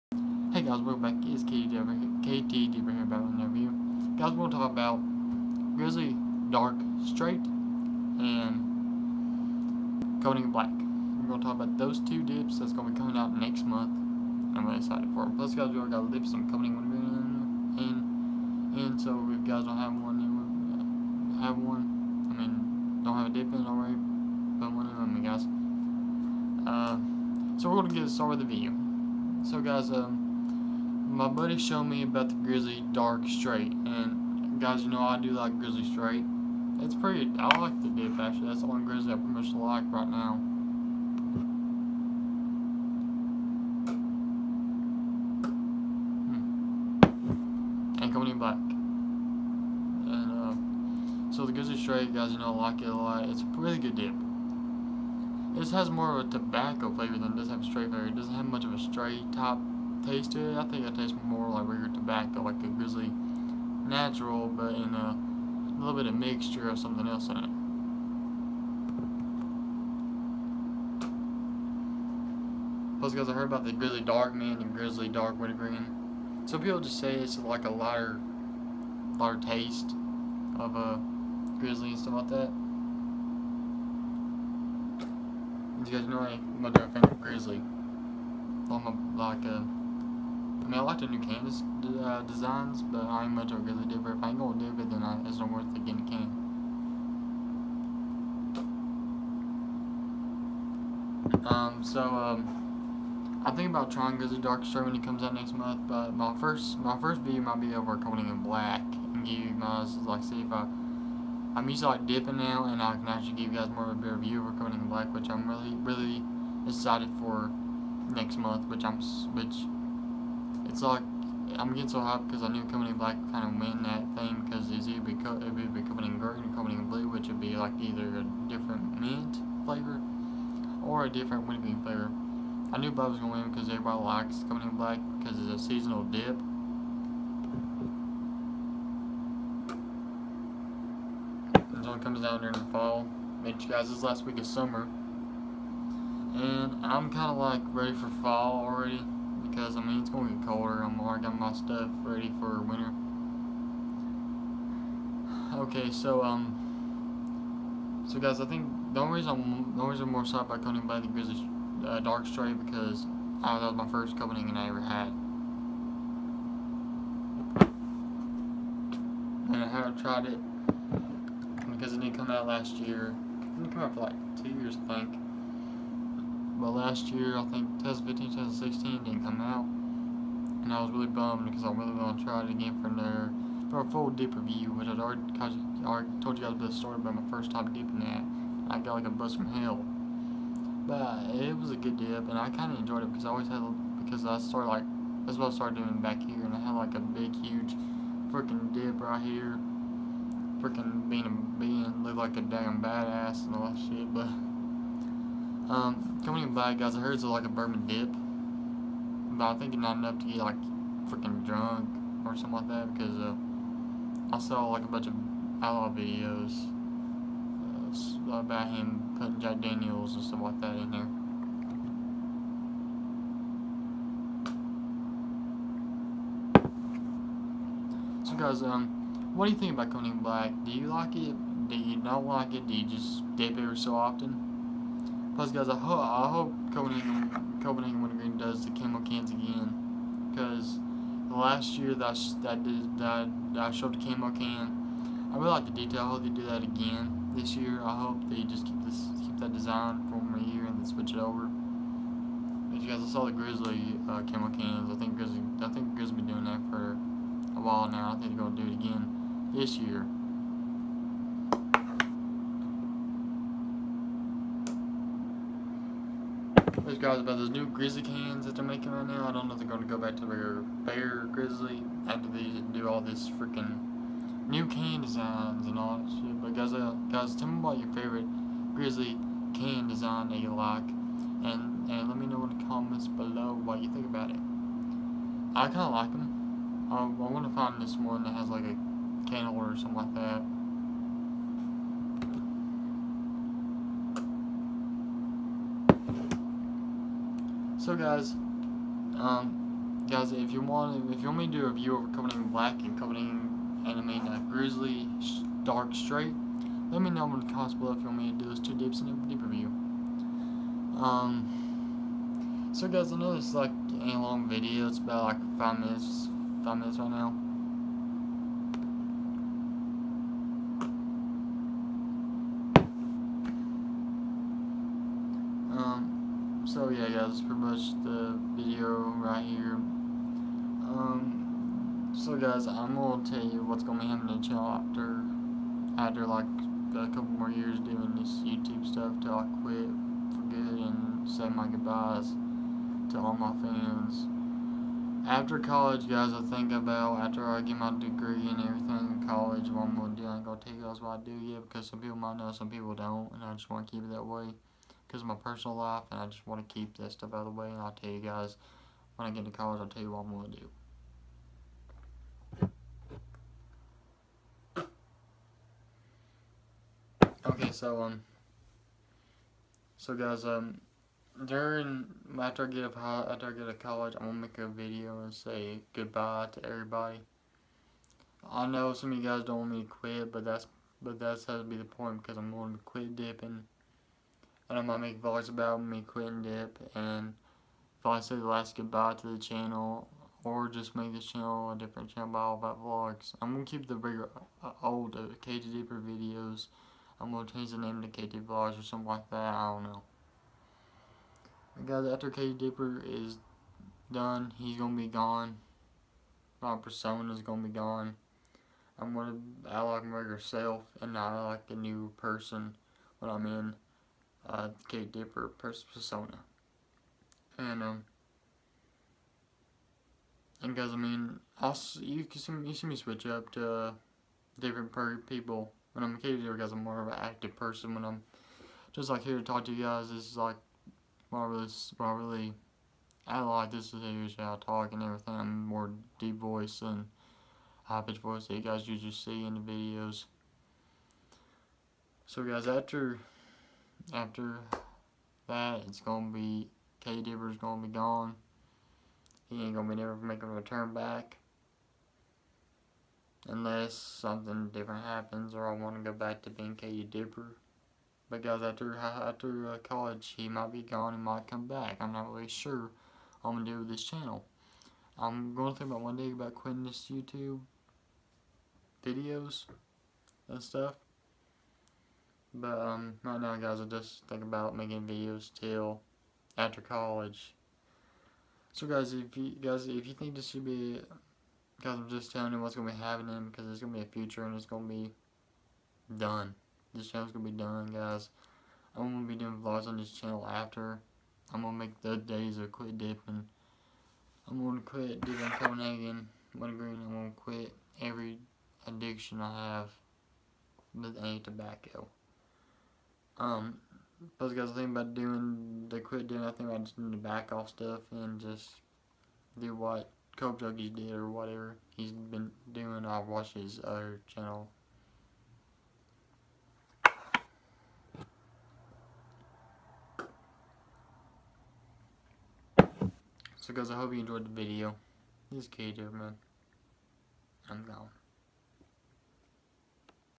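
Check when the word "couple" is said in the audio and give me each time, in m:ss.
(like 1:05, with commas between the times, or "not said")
5:37.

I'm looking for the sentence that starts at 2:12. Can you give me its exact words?
I knew Bob was gonna win because everybody likes Copenhagen Black because it's a seasonal dip.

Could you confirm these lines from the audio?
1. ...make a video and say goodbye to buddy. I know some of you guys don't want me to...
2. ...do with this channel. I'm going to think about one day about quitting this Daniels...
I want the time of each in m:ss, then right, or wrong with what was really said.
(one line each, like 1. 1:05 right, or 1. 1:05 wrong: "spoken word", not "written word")
1. 6:14 wrong: "everybody", not "buddy"
2. 7:43 wrong: "YouTube", not "Daniels".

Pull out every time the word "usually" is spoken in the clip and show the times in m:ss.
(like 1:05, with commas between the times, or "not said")
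7:14, 7:18.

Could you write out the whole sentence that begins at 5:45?
After college, guys, I think about after I get my degree and everything in college, what I'm gonna do.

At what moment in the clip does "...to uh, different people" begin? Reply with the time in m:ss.
7:03.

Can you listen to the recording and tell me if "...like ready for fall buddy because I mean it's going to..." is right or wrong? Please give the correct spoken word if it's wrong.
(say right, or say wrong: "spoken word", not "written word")
wrong: "already", not "buddy".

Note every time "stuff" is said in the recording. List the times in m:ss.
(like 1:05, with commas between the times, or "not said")
1:21, 2:31, 3:40, 5:38, 5:57, 7:50, 8:27.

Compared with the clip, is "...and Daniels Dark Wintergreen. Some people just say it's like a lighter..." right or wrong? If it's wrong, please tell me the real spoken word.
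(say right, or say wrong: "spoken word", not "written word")
wrong: "Grizzly", not "Daniels".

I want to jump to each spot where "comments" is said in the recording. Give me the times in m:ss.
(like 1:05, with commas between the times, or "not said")
4:42, 5:07.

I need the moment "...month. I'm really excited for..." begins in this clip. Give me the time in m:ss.
0:13.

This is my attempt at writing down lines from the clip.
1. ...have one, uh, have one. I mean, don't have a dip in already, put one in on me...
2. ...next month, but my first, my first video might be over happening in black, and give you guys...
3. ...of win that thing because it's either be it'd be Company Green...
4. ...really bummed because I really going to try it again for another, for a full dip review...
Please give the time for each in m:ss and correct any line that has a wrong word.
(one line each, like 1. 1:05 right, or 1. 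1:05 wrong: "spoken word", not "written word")
1. 0:19 right
2. 1:45 wrong: "recording", not "happening"
3. 2:03 right
4. 3:00 right.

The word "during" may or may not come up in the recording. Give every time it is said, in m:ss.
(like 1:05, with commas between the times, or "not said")
2:22, 6:11.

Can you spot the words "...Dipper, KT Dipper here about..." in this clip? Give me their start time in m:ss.
0:01.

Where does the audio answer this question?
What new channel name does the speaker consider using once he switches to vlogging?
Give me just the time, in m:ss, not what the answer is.
6:38.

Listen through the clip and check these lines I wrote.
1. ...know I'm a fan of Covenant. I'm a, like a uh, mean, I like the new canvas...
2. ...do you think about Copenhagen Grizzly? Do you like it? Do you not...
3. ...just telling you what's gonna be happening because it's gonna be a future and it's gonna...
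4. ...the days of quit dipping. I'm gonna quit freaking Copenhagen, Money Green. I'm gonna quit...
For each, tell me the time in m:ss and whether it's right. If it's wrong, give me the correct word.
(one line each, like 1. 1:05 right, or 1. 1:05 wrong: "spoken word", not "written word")
1. 1:26 wrong: "Grizzly", not "Covenant"
2. 3:49 wrong: "Black", not "Grizzly"
3. 8:02 right
4. 8:12 wrong: "dipping", not "freaking".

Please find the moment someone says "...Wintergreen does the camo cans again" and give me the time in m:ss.
3:58.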